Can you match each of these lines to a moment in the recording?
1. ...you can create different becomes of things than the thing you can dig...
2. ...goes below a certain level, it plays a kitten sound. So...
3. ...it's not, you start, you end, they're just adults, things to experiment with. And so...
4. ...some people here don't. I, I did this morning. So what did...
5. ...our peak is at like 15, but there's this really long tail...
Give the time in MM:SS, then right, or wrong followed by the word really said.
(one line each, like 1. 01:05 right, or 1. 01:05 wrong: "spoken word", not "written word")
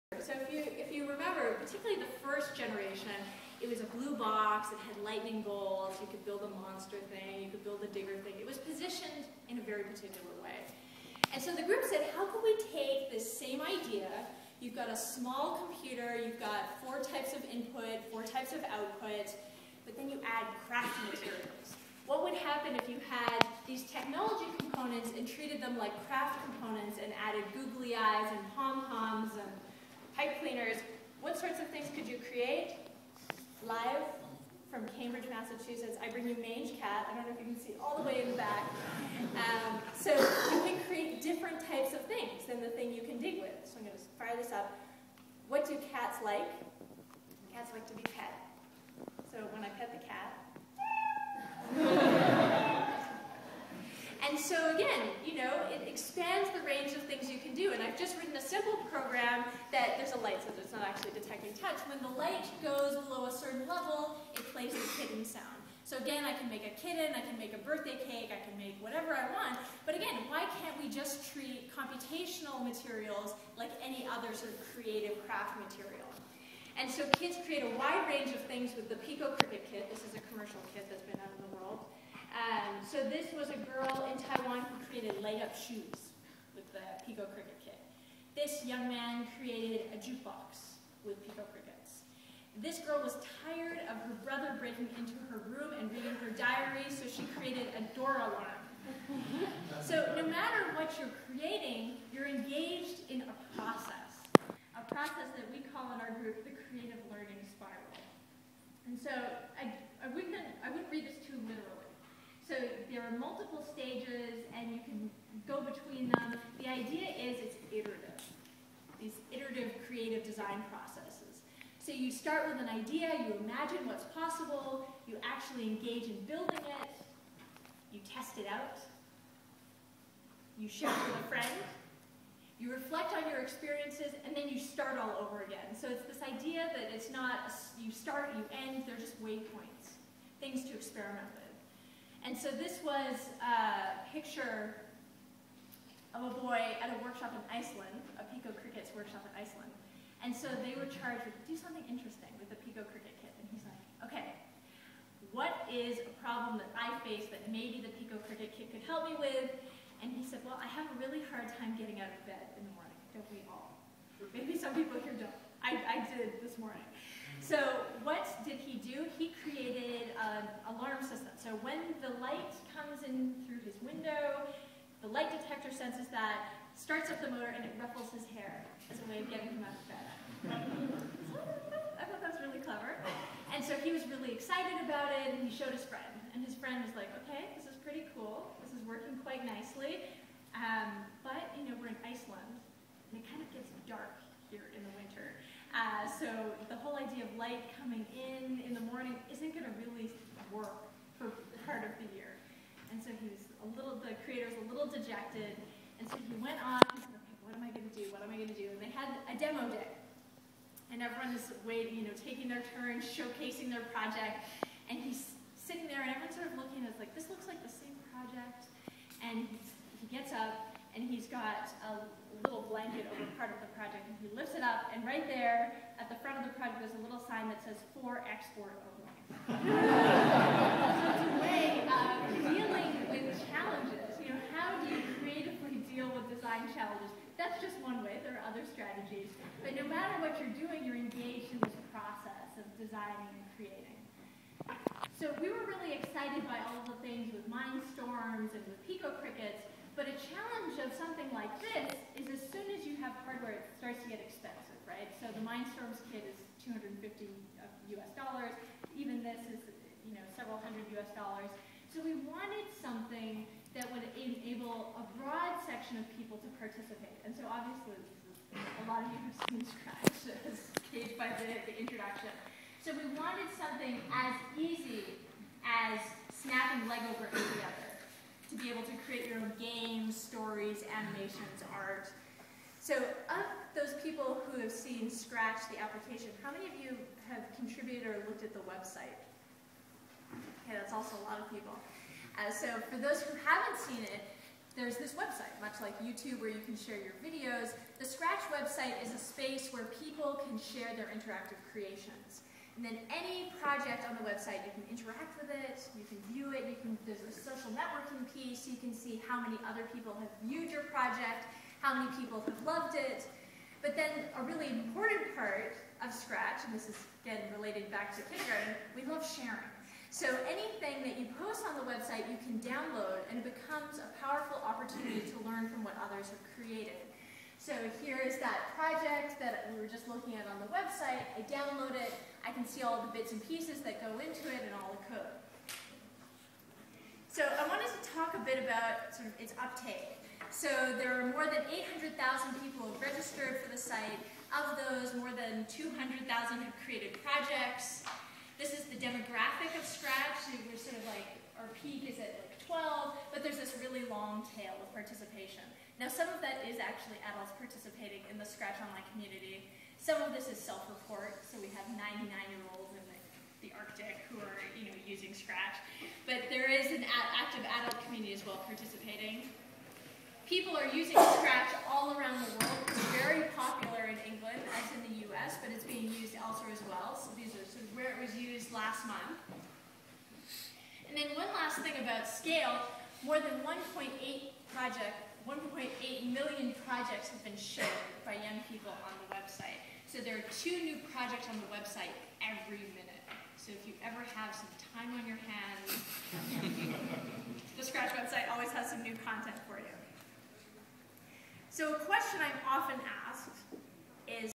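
1. 00:40 wrong: "types", not "becomes"
2. 01:02 right
3. 02:16 wrong: "waypoints", not "adults"
4. 02:44 right
5. 05:51 wrong: "12", not "15".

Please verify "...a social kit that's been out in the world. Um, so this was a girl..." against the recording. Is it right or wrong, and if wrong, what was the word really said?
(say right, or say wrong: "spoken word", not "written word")
wrong: "commercial", not "social".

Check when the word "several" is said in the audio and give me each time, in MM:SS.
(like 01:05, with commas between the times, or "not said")
04:20.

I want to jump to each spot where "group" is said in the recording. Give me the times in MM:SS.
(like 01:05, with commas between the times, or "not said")
00:11, 01:46.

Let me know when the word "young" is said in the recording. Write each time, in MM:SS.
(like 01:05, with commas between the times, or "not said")
01:28, 06:28.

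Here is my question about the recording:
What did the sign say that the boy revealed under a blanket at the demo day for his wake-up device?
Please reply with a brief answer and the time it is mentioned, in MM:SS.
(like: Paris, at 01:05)
For export only, at 03:47.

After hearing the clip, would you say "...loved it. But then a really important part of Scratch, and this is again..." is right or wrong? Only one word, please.
right.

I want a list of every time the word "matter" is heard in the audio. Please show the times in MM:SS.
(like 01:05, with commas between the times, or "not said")
01:40, 03:59.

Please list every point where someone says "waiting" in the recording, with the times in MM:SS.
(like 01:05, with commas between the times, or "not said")
03:31.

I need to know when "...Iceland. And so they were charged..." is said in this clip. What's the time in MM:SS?
02:29.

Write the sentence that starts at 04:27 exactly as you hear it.
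And so obviously, a lot of you have seen Scratch as by the, the introduction.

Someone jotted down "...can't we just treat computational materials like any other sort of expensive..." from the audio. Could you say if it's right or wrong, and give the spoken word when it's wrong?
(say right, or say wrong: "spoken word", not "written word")
wrong: "creative", not "expensive".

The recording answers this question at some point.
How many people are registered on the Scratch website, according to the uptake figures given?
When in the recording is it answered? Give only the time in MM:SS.
05:41.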